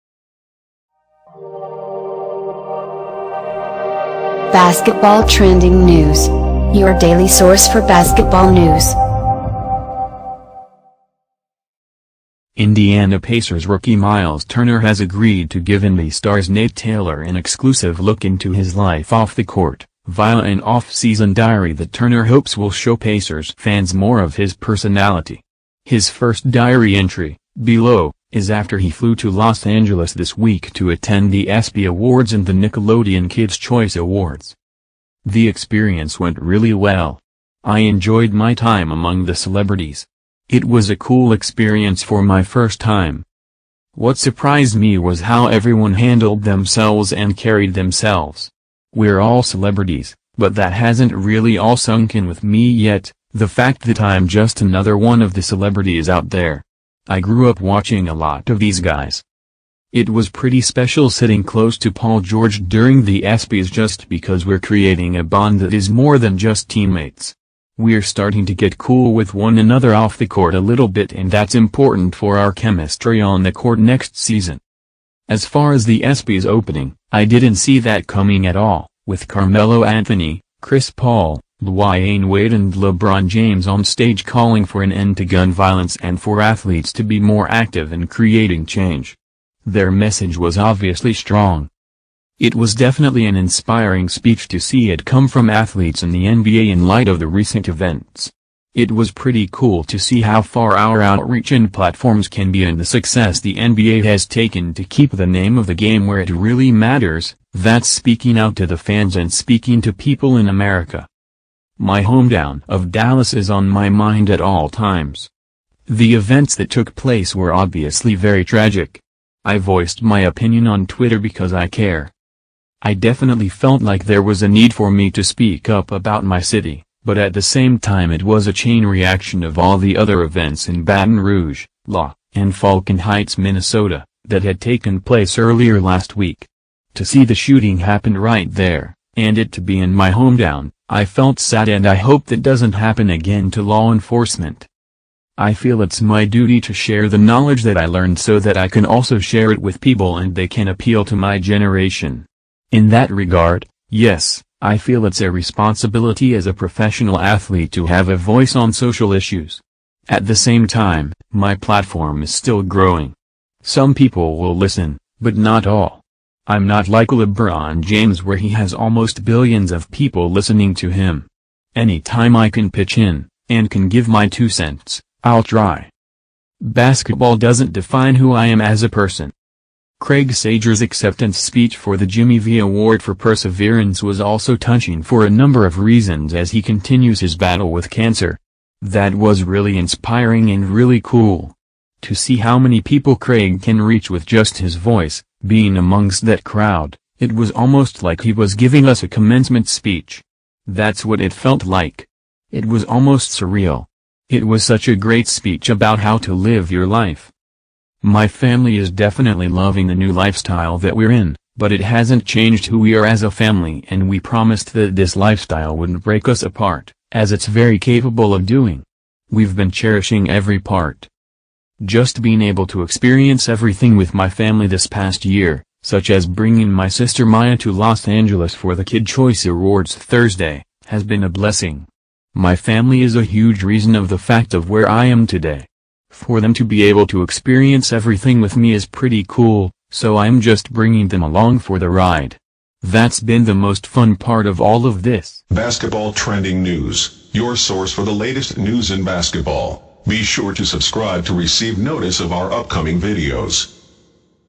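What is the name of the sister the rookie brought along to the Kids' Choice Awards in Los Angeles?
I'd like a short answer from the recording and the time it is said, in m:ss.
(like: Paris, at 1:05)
Maya, at 3:47.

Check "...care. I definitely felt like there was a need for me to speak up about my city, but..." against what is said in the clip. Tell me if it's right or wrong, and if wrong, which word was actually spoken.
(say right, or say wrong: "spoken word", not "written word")
right.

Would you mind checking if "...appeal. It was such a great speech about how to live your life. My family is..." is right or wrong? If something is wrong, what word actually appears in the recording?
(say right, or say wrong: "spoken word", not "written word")
wrong: "surreal", not "appeal".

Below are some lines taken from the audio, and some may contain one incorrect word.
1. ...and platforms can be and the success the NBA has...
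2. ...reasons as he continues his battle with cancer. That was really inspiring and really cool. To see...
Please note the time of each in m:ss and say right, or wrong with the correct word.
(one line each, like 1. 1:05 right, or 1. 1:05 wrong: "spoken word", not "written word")
1. 1:41 right
2. 3:05 right.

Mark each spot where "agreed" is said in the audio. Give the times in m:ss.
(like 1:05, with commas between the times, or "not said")
0:14.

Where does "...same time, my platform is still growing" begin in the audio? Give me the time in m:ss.
2:40.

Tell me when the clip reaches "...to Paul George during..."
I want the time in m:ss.
1:01.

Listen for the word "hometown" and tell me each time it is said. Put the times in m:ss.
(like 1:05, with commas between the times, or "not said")
1:52, 2:20.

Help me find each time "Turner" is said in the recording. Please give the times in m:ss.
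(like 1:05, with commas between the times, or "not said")
0:14, 0:21.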